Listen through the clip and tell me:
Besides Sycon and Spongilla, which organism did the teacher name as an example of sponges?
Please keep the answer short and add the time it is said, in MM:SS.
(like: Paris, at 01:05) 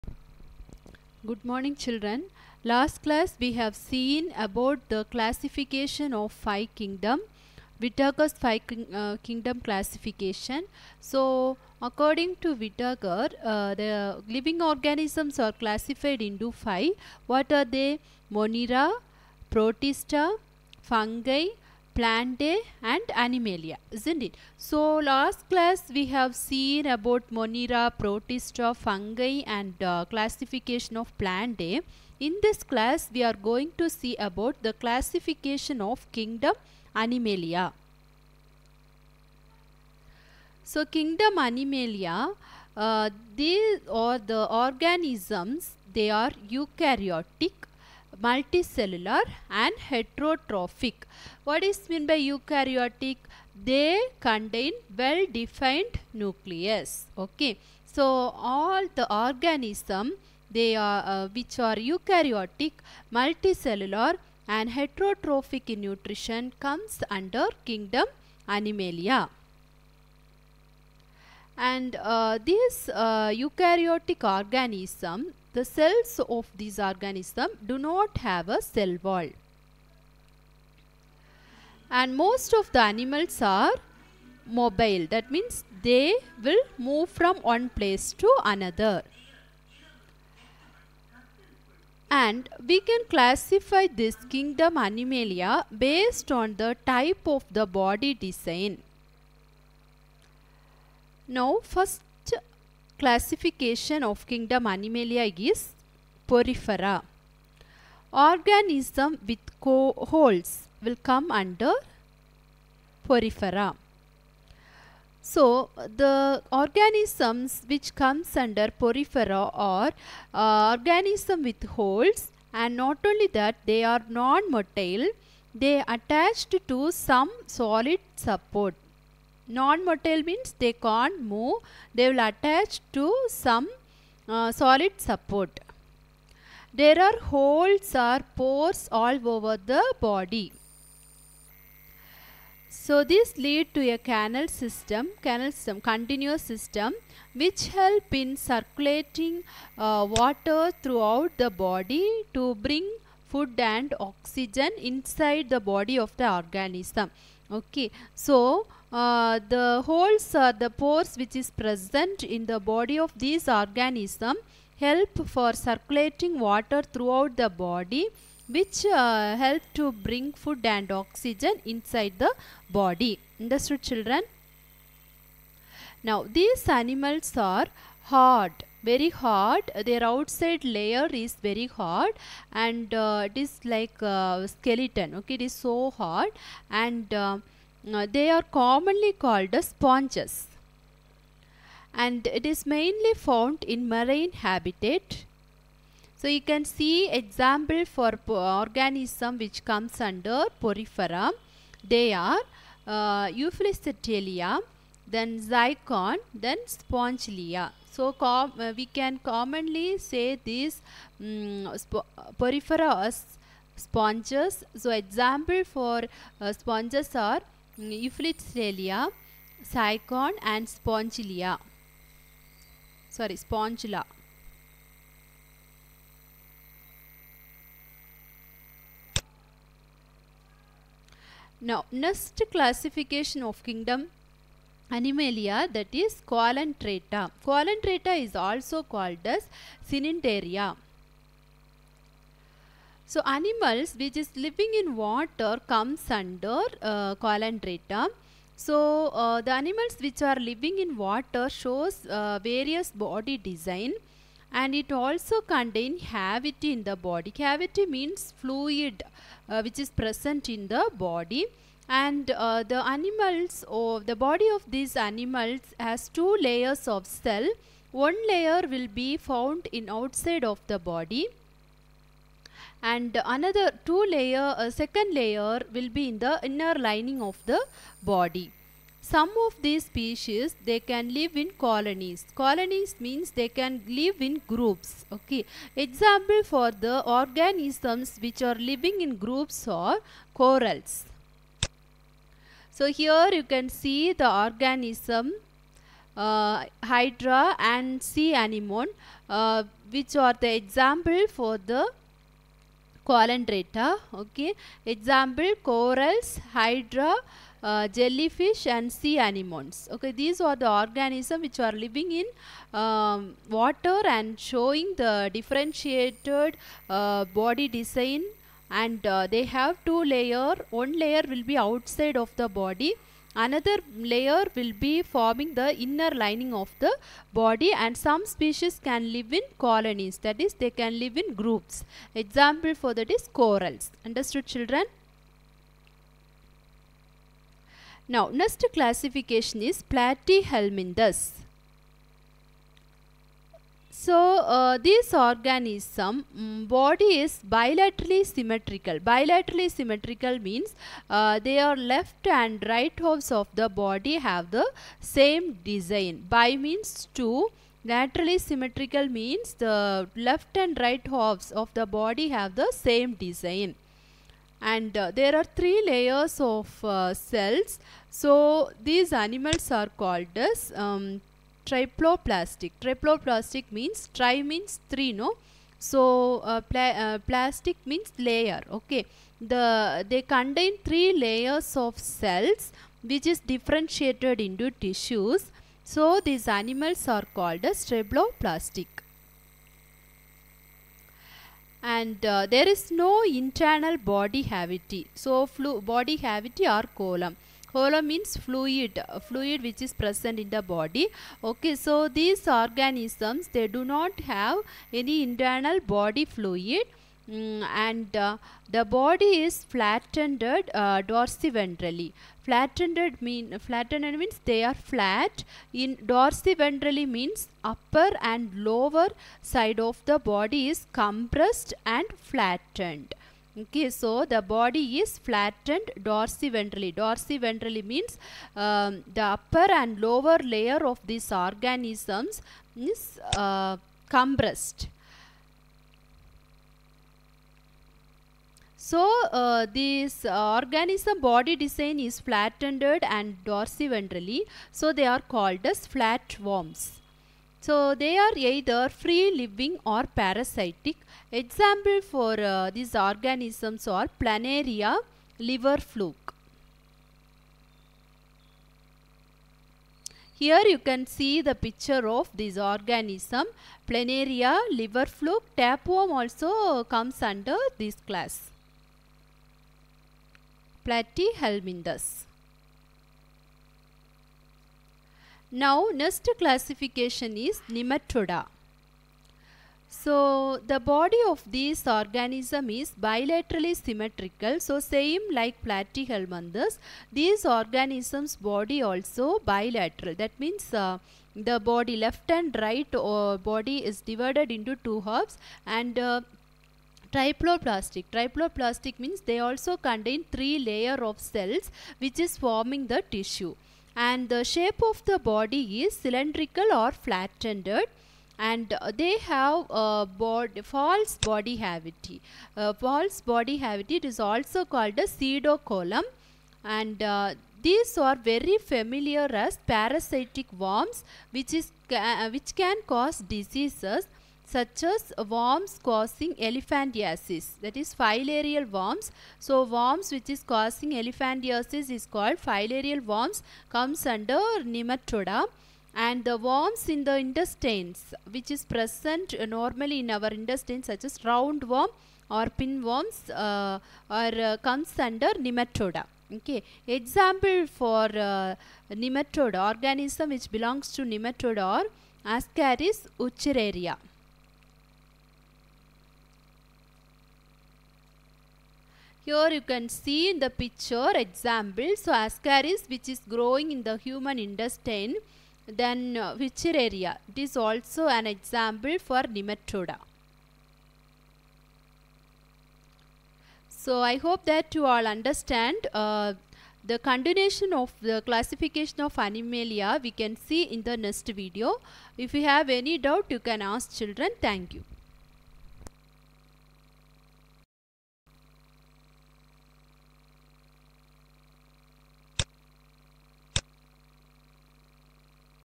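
Euplectelia, at 03:37.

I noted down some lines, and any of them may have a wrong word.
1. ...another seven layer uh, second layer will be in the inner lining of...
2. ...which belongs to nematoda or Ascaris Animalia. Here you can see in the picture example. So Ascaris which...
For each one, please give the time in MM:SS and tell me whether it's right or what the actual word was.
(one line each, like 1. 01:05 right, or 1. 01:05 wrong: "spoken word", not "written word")
1. 04:33 wrong: "two", not "seven"
2. 09:10 wrong: "Wuchereria", not "Animalia".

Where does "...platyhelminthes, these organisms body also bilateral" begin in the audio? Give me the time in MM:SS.
08:05.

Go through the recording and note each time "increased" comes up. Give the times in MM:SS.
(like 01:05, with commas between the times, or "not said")
not said.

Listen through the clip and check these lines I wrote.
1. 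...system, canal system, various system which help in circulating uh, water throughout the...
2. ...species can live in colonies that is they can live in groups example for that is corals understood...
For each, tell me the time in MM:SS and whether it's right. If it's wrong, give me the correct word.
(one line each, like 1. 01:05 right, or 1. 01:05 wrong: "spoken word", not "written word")
1. 02:24 wrong: "continuous", not "various"
2. 05:28 right.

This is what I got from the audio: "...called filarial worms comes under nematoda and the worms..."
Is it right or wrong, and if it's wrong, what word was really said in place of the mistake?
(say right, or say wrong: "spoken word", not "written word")
right.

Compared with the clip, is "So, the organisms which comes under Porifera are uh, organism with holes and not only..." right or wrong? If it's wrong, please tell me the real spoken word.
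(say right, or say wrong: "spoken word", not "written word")
right.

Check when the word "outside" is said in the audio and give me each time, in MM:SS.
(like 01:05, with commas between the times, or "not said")
03:00, 04:29, 05:21.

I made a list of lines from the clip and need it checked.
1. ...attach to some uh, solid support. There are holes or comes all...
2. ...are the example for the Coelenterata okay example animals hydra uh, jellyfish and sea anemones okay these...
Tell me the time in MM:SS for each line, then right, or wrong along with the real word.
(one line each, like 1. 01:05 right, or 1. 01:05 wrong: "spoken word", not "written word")
1. 02:12 wrong: "pores", not "comes"
2. 05:00 wrong: "corals", not "animals".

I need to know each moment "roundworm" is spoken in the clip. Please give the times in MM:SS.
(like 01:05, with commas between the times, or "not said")
09:01.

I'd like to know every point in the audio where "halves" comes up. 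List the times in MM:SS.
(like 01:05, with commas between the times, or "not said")
05:52, 06:01, 08:15.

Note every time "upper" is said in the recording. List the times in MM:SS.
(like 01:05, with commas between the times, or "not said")
06:57, 07:09.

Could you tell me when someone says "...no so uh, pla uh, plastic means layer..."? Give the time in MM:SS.
06:15.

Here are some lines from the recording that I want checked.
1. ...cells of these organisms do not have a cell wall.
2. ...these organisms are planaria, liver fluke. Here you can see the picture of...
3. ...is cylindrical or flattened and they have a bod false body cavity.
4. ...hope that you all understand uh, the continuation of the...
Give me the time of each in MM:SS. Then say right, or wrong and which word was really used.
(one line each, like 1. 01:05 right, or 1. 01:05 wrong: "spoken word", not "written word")
1. 01:15 right
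2. 07:32 right
3. 08:25 right
4. 09:34 right.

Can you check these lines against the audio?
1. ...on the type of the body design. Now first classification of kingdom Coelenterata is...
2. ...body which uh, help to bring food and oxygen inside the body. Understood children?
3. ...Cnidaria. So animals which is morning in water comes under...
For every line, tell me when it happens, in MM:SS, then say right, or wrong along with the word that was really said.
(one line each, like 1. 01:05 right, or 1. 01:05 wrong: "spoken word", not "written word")
1. 01:36 wrong: "Animalia", not "Coelenterata"
2. 02:47 right
3. 03:59 wrong: "living", not "morning".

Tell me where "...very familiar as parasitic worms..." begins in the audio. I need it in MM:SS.
08:38.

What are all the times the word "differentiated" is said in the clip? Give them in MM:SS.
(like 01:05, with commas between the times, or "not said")
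05:15, 06:23.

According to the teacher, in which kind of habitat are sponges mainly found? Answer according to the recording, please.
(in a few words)
Marine habitat.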